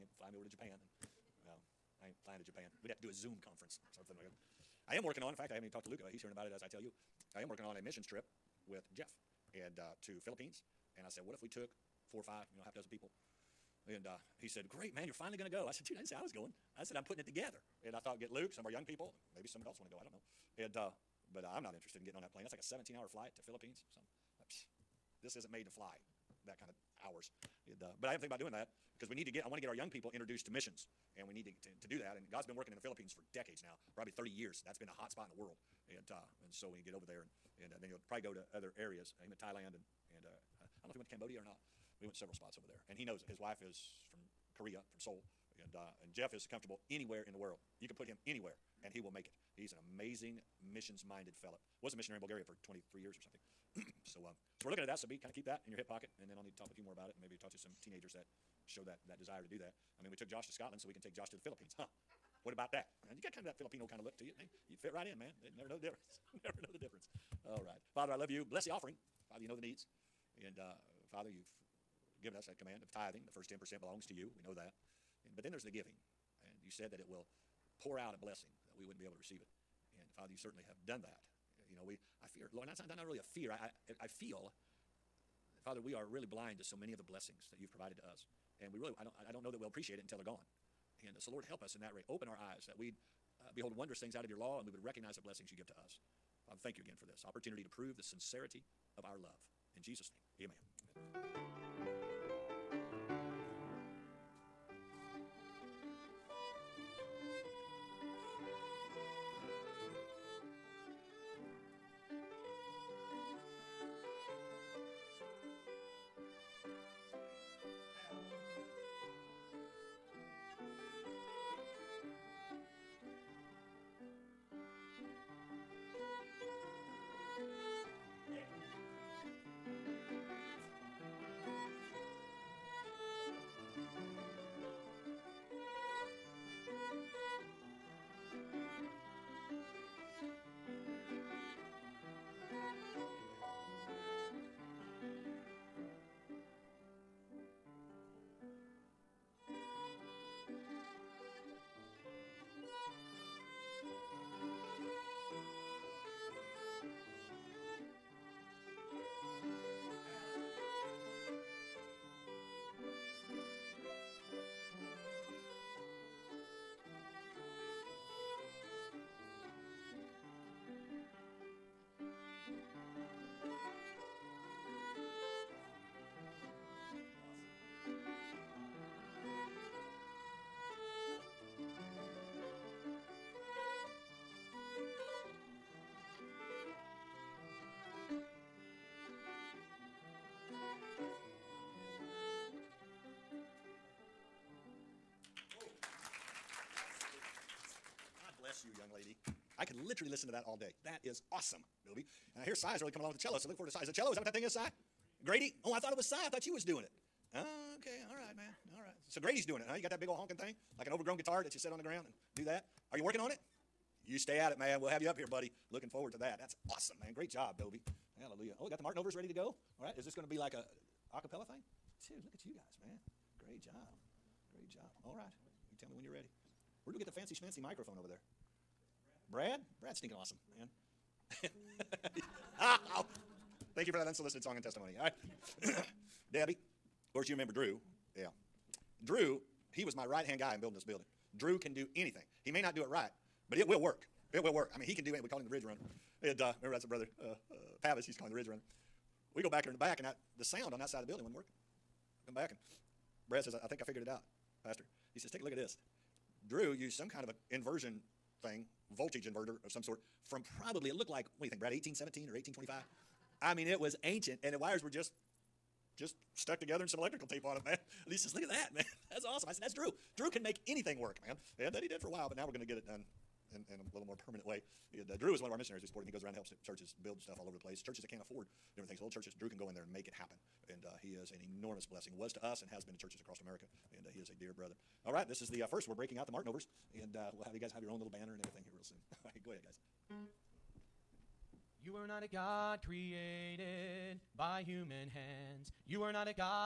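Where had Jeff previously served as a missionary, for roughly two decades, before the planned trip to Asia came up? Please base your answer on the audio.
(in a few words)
Bulgaria.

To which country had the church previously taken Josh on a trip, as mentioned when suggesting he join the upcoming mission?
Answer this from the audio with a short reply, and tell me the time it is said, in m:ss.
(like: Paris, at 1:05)
Scotland, at 1:00.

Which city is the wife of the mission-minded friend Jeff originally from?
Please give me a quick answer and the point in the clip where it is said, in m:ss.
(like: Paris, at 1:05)
Seoul, at 0:44.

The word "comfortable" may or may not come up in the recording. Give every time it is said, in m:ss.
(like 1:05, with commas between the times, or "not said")
0:46.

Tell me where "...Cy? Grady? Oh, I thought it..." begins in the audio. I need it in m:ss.
3:24.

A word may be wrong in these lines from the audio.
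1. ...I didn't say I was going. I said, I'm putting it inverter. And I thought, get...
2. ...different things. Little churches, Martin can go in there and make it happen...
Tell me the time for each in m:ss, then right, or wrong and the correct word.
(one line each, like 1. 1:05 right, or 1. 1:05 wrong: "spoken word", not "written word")
1. 0:15 wrong: "together", not "inverter"
2. 4:38 wrong: "Drew", not "Martin".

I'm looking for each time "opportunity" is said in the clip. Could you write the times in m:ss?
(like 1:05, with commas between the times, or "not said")
1:37.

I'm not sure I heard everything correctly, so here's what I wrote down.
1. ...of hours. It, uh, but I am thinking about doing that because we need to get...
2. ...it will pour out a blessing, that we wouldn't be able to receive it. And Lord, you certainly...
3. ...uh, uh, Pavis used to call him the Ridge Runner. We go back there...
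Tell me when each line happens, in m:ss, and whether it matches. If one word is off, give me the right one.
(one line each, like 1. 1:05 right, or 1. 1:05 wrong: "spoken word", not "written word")
1. 0:26 right
2. 1:16 wrong: "Father", not "Lord"
3. 4:07 right.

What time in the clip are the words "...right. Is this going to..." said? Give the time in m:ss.
3:39.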